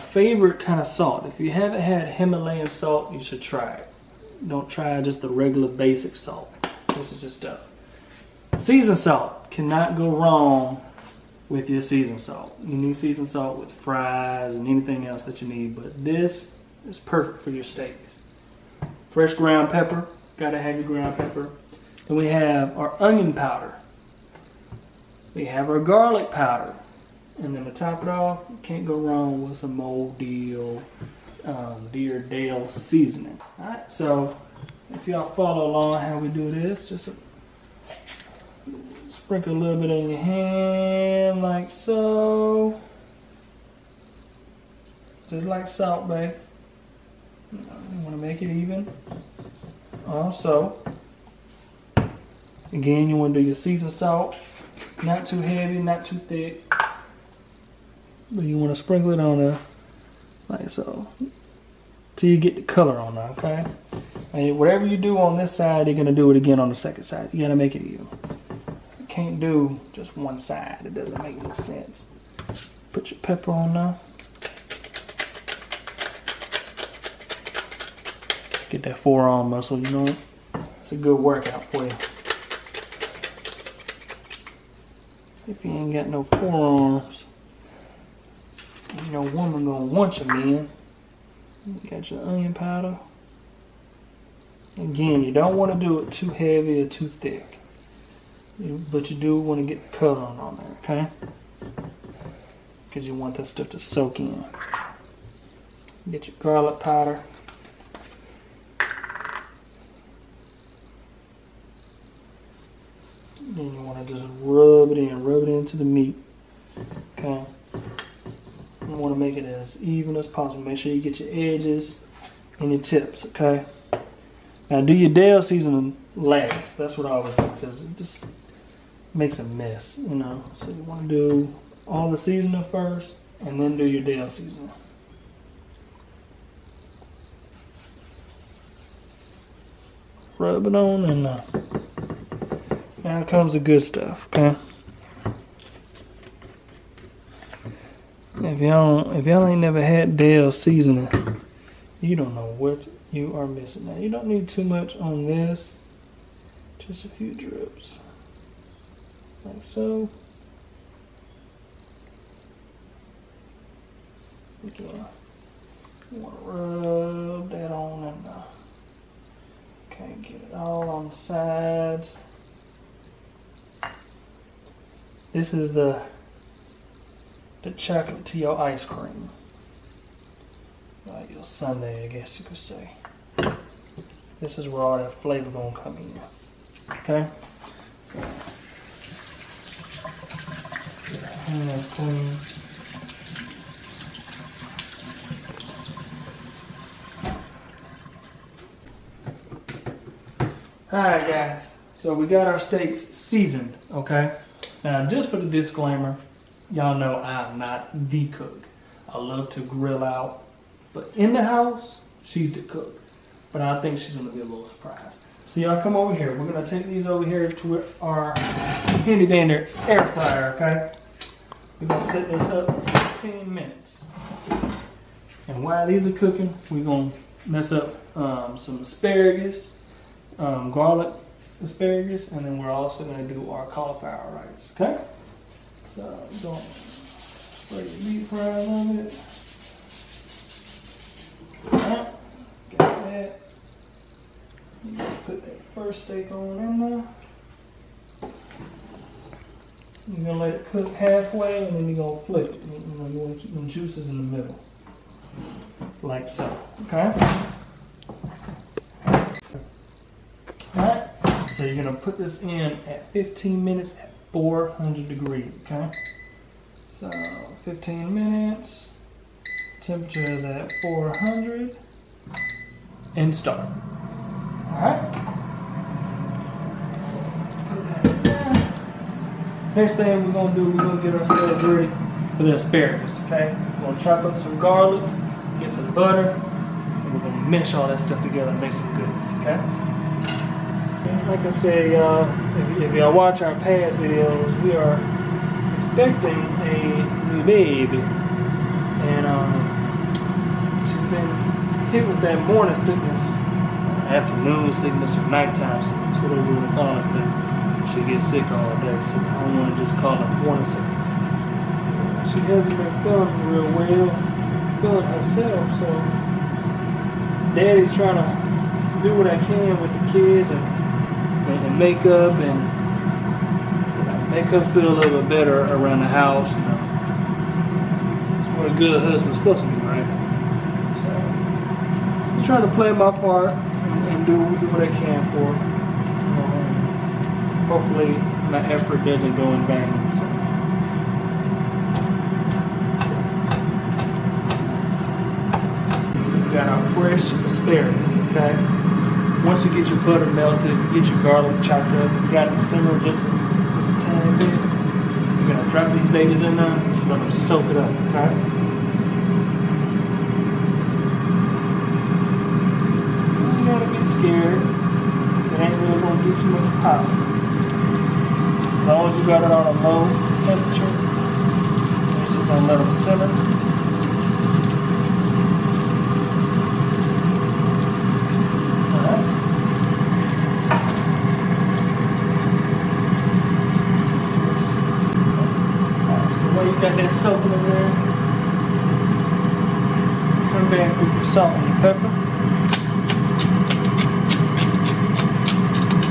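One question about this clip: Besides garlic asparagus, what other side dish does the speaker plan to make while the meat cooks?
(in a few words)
Cauliflower rice.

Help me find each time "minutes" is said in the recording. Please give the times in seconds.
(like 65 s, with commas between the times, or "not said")
223 s, 263 s, 268 s.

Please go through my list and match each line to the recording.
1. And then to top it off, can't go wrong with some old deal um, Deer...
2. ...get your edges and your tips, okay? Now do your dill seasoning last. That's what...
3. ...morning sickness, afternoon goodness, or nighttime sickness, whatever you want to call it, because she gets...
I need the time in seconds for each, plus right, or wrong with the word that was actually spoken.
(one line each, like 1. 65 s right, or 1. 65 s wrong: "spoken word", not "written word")
1. 27 s right
2. 121 s right
3. 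302 s wrong: "sickness", not "goodness".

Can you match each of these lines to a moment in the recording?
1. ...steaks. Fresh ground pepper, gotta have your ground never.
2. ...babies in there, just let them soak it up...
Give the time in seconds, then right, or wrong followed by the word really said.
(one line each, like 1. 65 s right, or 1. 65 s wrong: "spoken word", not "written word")
1. 17 s wrong: "pepper", not "never"
2. 356 s right.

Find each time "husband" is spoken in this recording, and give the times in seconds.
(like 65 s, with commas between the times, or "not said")
329 s.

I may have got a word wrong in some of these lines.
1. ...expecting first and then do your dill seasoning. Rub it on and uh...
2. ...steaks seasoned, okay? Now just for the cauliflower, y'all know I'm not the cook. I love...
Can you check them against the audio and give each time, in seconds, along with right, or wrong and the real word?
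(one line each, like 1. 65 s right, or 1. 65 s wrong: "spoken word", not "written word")
1. 132 s wrong: "seasoning", not "expecting"
2. 202 s wrong: "disclaimer", not "cauliflower".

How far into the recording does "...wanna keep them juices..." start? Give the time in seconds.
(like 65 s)
253 s.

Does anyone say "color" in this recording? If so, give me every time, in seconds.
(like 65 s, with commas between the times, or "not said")
62 s, 99 s.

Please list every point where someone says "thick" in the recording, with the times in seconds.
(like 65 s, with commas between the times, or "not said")
56 s, 97 s.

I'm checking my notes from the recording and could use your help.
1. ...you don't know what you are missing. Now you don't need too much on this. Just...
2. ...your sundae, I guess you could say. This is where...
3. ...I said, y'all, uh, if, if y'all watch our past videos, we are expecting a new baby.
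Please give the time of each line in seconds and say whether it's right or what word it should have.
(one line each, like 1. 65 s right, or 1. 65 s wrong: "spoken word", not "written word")
1. 152 s right
2. 181 s right
3. 291 s right.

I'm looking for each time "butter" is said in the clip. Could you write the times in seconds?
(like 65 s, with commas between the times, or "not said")
285 s, 350 s.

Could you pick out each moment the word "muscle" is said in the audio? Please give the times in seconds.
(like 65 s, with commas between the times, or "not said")
79 s.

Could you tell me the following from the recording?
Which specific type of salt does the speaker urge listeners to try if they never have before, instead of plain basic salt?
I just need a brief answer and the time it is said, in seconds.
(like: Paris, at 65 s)
Himalayan salt, at 2 s.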